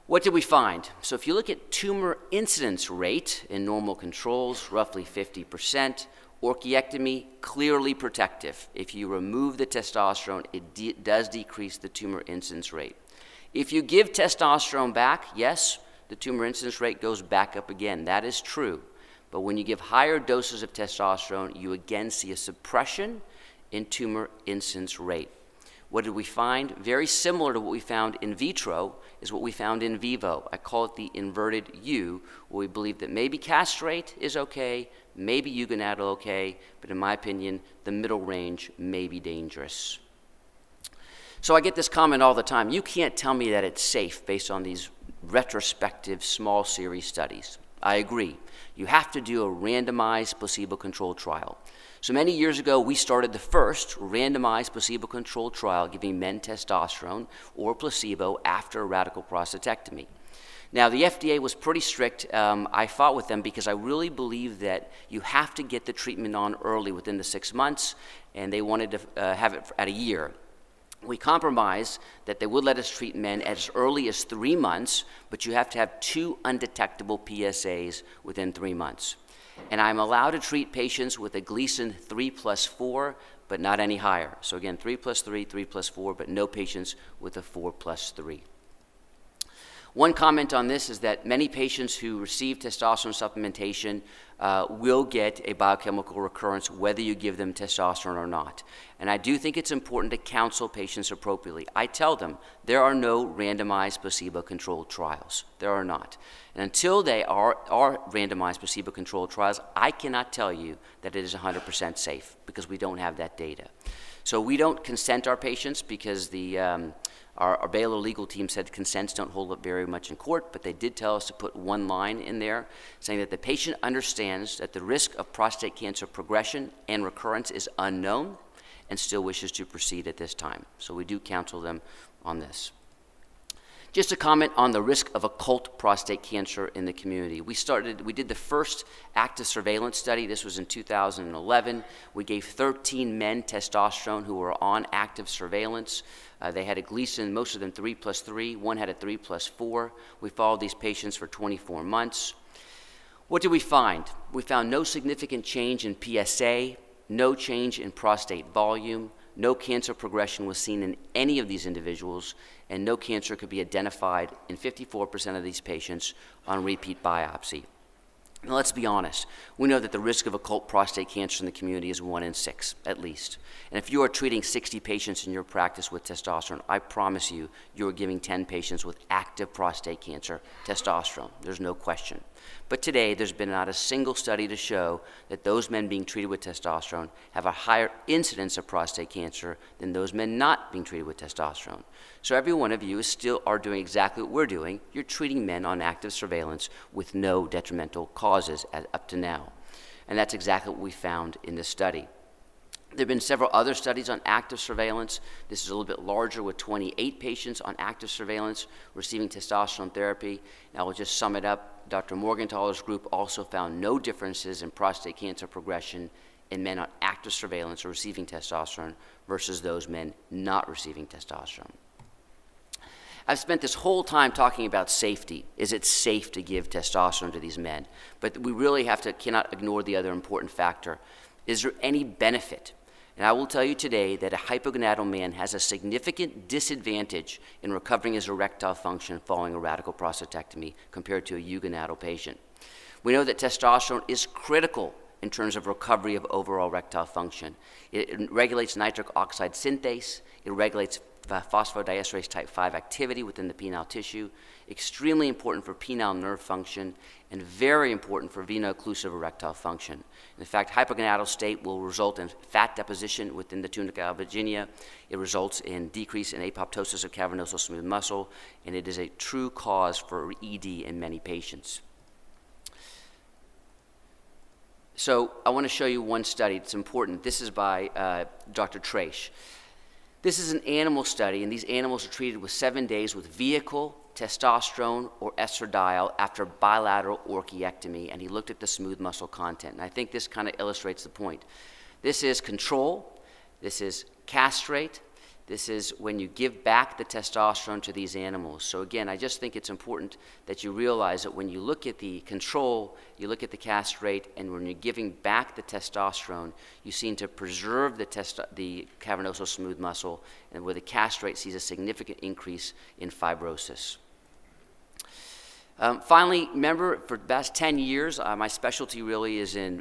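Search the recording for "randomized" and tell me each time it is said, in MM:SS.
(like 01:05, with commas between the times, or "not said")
00:49, 00:54, 01:43, 01:48.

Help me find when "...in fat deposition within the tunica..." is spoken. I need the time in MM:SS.
04:22.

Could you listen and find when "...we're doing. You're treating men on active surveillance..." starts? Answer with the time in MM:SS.
03:14.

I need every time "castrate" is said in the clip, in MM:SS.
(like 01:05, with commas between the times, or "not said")
00:33, 04:54, 05:03, 05:10.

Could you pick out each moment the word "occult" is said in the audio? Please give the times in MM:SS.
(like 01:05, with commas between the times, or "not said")
02:15, 02:50.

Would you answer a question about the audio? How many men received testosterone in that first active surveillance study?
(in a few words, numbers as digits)
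13.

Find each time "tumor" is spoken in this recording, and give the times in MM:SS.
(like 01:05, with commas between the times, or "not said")
00:01, 00:11, 00:16, 00:23.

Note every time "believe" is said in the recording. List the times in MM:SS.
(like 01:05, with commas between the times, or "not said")
00:32, 01:04.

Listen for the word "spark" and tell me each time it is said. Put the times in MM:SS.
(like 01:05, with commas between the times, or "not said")
not said.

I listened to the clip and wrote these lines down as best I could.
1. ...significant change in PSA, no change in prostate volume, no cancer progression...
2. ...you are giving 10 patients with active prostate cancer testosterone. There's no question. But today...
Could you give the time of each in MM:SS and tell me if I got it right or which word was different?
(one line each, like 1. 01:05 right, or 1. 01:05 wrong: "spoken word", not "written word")
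1. 02:34 right
2. 02:57 right.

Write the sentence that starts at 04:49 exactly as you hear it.
And I think this kind of illustrates the point.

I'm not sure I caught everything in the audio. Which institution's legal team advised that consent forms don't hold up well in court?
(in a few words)
Baylor.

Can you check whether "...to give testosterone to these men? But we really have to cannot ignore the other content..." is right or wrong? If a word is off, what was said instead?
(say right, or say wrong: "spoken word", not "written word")
wrong: "important", not "content".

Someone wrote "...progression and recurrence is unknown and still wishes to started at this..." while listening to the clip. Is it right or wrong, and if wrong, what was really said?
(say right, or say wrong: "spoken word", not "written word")
wrong: "proceed", not "started".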